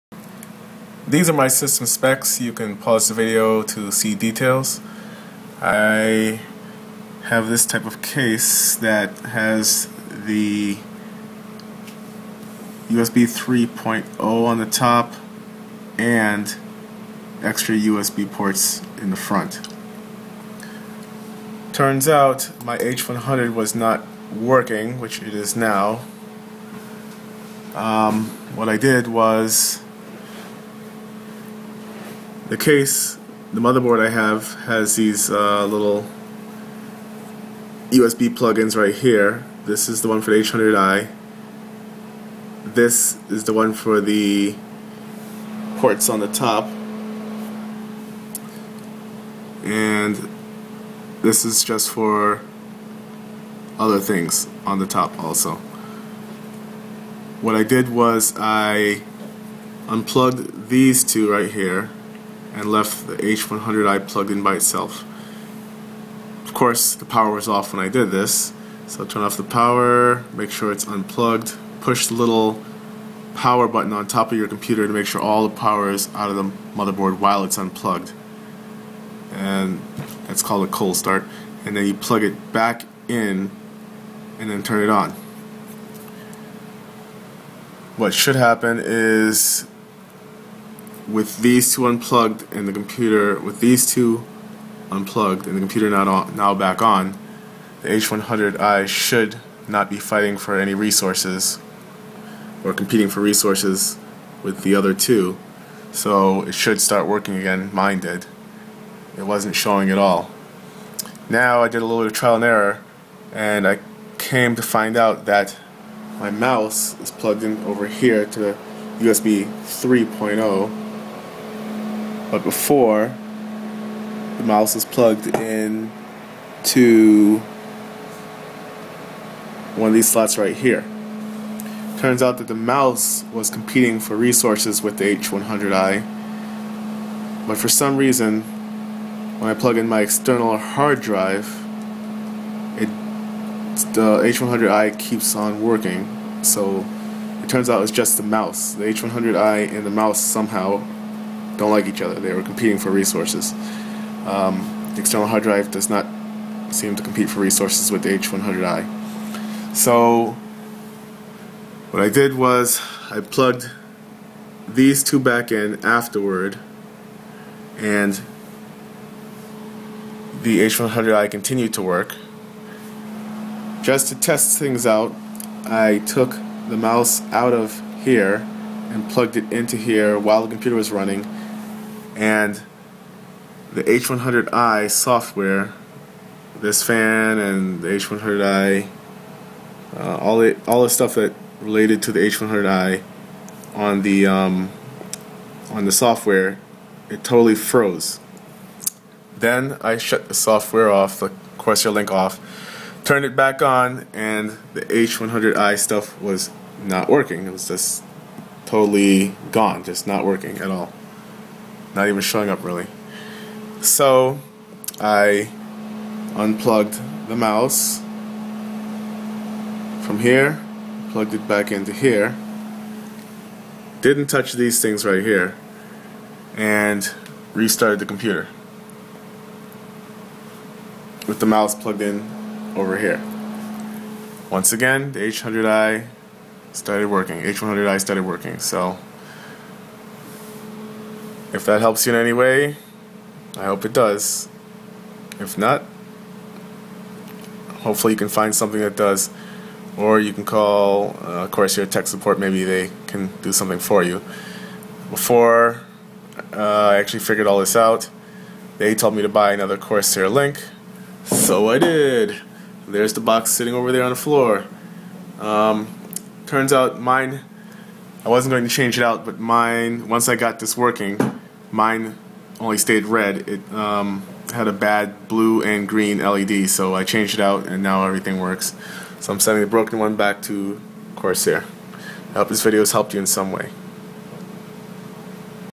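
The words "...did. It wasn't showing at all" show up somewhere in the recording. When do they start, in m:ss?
1:47.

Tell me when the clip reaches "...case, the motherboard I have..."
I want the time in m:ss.
0:32.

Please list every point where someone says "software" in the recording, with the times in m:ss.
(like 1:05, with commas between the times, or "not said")
3:04, 3:15, 3:20.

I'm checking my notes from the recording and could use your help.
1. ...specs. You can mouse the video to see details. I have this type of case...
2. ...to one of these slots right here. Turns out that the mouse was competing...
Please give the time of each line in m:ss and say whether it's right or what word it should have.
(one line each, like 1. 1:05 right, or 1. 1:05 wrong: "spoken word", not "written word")
1. 0:01 wrong: "pause", not "mouse"
2. 2:06 right.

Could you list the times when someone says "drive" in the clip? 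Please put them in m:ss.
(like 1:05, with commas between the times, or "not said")
2:21, 2:35.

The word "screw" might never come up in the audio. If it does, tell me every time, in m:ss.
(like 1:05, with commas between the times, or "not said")
not said.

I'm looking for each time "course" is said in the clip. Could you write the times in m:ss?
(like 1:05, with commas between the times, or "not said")
1:06, 4:11.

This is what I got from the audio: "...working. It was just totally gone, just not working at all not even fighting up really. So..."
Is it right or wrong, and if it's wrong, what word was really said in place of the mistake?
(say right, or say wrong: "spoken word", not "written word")
wrong: "showing", not "fighting".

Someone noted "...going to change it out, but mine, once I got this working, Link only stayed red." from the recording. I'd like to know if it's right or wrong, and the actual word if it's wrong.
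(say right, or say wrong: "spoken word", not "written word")
wrong: "Mine", not "Link".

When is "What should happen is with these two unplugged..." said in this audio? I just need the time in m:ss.
1:27.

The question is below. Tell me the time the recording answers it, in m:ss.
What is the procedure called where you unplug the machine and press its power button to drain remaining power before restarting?
1:20.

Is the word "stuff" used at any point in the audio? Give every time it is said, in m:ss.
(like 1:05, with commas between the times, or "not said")
3:10, 3:25.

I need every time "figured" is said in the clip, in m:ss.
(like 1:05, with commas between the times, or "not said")
4:17.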